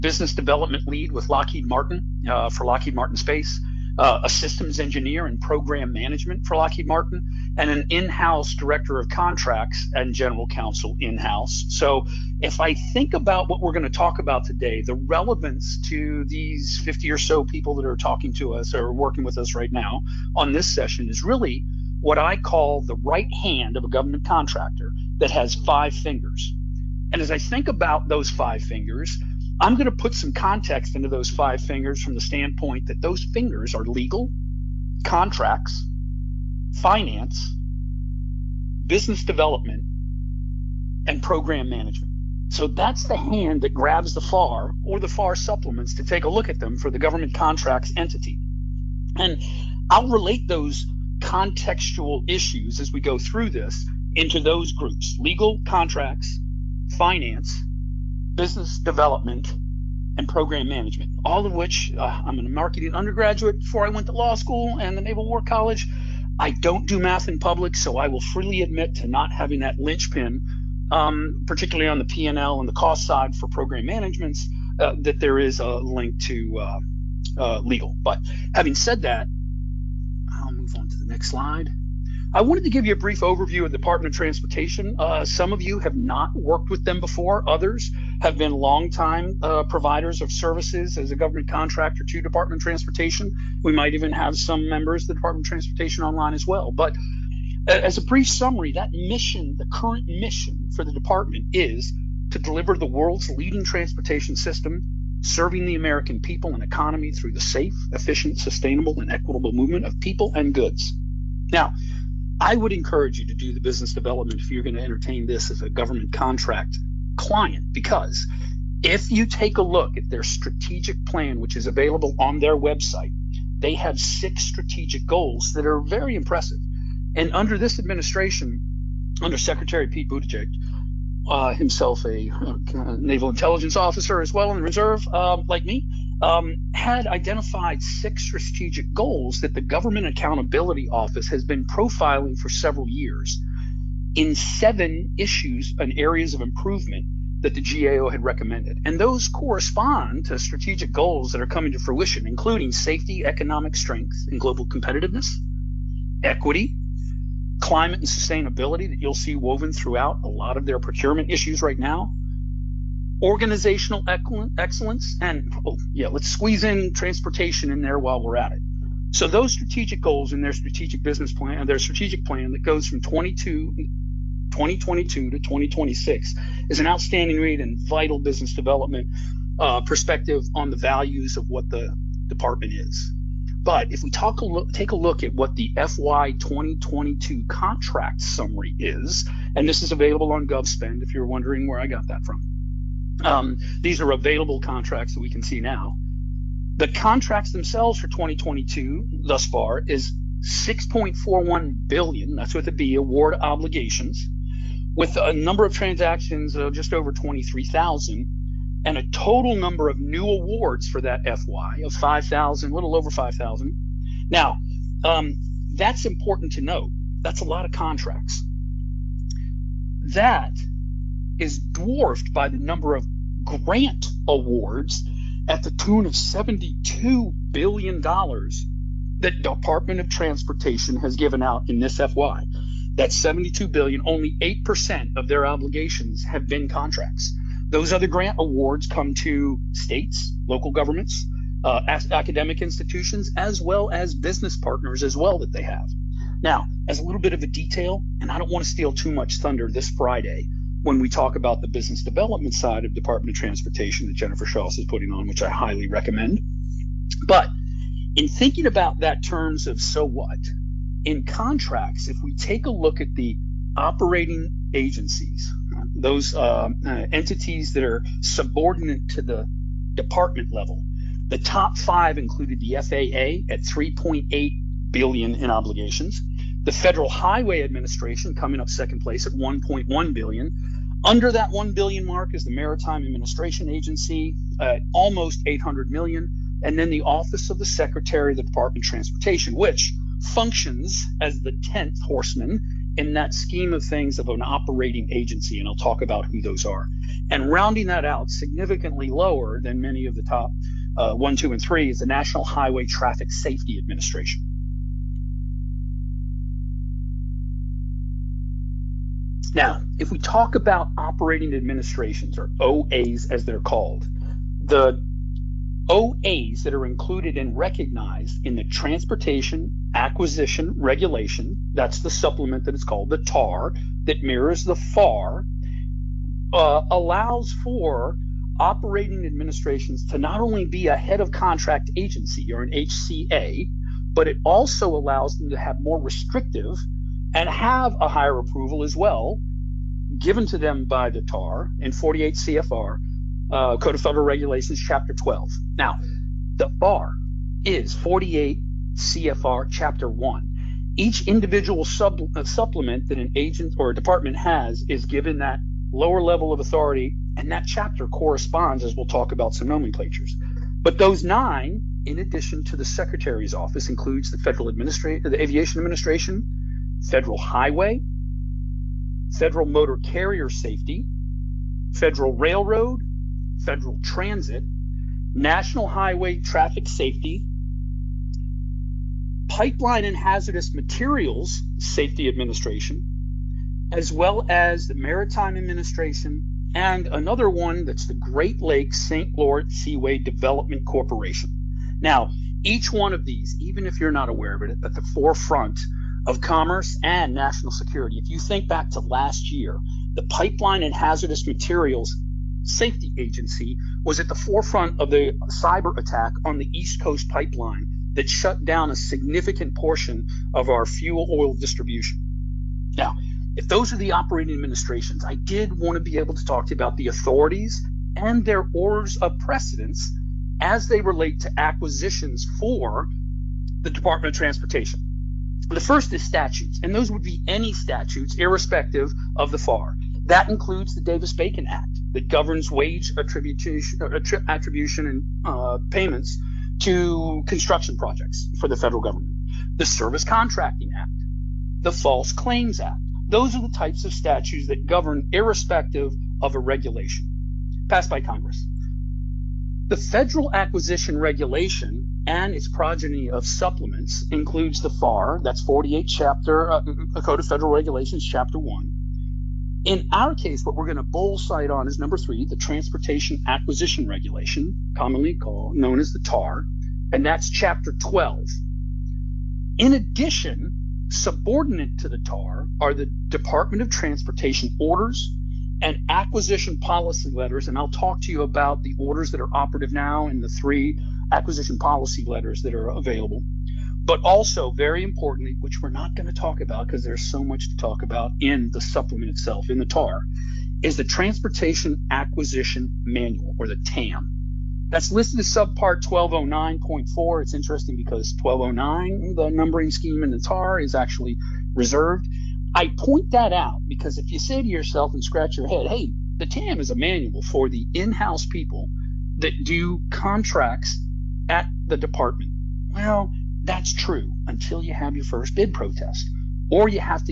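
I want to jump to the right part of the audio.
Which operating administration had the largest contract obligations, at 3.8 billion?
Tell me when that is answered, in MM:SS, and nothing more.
04:32.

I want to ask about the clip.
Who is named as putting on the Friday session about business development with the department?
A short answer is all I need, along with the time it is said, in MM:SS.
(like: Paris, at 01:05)
Jennifer Schaus, at 04:14.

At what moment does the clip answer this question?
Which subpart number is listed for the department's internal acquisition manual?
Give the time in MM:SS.
08:16.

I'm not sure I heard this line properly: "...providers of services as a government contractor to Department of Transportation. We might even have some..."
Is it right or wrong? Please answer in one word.
right.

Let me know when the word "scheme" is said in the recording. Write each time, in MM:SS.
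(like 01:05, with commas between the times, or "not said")
04:53, 08:19.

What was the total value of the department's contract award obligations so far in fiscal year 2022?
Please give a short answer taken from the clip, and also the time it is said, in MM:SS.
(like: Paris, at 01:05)
6.41 billion, at 03:20.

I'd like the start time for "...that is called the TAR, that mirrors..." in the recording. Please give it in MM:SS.
05:22.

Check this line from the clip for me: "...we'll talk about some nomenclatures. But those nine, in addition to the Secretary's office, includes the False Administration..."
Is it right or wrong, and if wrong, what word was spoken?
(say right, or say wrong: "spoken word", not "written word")
wrong: "Federal", not "False".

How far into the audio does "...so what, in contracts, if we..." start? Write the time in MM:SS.
04:19.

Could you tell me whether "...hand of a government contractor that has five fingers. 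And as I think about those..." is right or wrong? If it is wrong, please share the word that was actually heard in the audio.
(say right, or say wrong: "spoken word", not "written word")
right.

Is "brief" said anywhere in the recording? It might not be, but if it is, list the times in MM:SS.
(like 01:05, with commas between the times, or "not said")
01:22, 01:38.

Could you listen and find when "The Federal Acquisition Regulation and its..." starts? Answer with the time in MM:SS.
07:29.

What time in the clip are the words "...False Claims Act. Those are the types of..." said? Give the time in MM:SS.
07:21.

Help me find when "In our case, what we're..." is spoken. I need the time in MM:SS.
07:39.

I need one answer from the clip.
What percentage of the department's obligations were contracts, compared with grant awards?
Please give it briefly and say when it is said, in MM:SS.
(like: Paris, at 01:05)
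8%, at 03:54.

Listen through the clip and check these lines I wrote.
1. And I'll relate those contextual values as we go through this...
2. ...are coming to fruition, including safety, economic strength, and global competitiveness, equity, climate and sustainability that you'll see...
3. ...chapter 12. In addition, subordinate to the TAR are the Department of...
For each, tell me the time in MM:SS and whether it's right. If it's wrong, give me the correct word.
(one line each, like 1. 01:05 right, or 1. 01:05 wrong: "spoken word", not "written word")
1. 00:49 wrong: "issues", not "values"
2. 02:31 right
3. 07:47 right.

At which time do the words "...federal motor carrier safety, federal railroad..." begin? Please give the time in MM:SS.
06:09.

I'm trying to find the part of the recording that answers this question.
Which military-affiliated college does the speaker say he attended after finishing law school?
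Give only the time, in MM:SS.
01:05.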